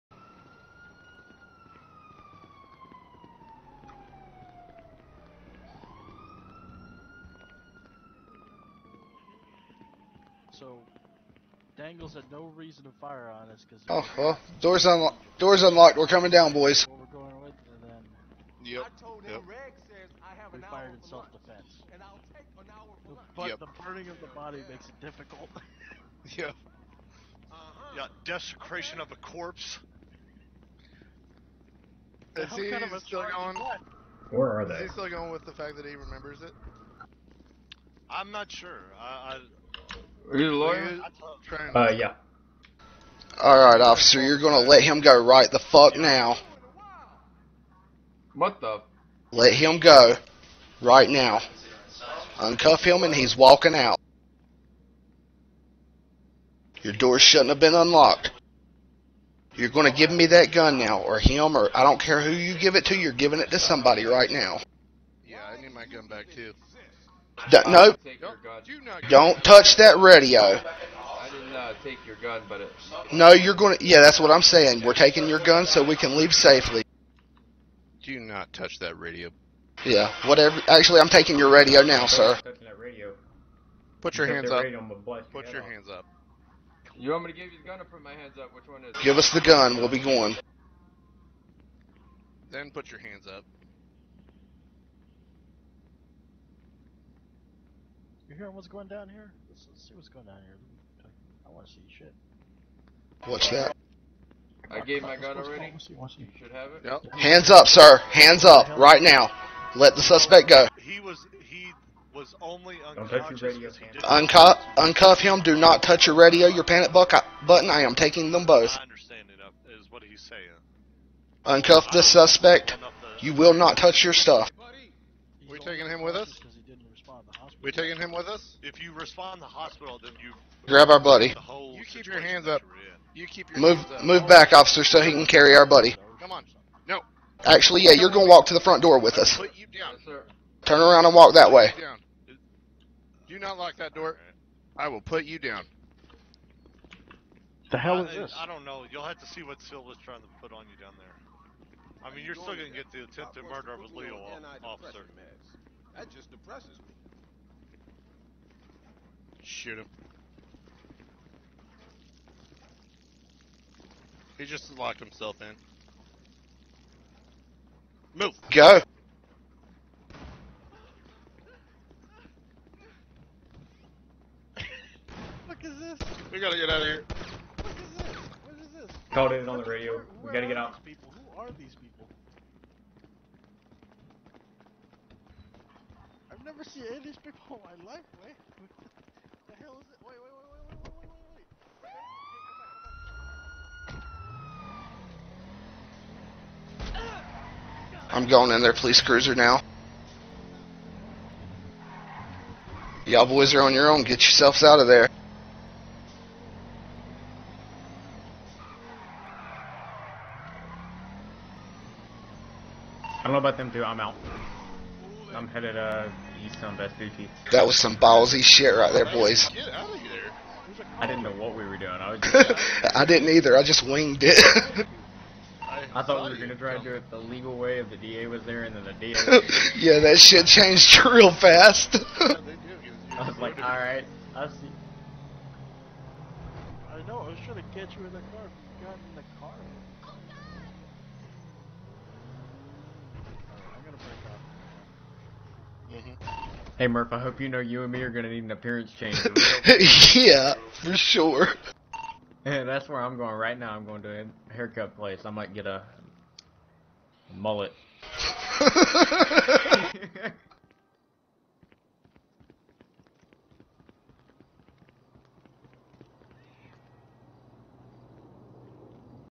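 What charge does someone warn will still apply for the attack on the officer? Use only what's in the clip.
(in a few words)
attempted murder.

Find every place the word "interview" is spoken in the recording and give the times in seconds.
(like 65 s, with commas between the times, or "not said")
not said.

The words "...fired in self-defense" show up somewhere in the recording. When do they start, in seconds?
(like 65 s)
20 s.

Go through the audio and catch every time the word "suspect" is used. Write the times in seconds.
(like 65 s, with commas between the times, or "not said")
110 s, 122 s.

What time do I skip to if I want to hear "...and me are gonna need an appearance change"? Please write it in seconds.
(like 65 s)
247 s.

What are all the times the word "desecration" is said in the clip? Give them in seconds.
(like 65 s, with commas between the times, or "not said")
28 s.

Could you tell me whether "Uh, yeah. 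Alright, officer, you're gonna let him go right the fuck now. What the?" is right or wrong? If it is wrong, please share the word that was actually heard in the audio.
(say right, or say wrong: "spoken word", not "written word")
right.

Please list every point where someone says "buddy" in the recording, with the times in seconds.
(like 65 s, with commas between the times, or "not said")
130 s, 135 s.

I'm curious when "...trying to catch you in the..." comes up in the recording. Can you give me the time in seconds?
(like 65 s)
237 s.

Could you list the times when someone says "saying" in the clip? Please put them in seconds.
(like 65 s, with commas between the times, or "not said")
74 s, 120 s.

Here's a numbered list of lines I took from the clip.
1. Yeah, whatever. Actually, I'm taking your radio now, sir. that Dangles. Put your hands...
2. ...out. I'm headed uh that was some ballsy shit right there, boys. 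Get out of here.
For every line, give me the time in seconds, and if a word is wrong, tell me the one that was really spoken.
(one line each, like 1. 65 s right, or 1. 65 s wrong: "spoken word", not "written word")
1. 79 s wrong: "Radio", not "Dangles"
2. 213 s right.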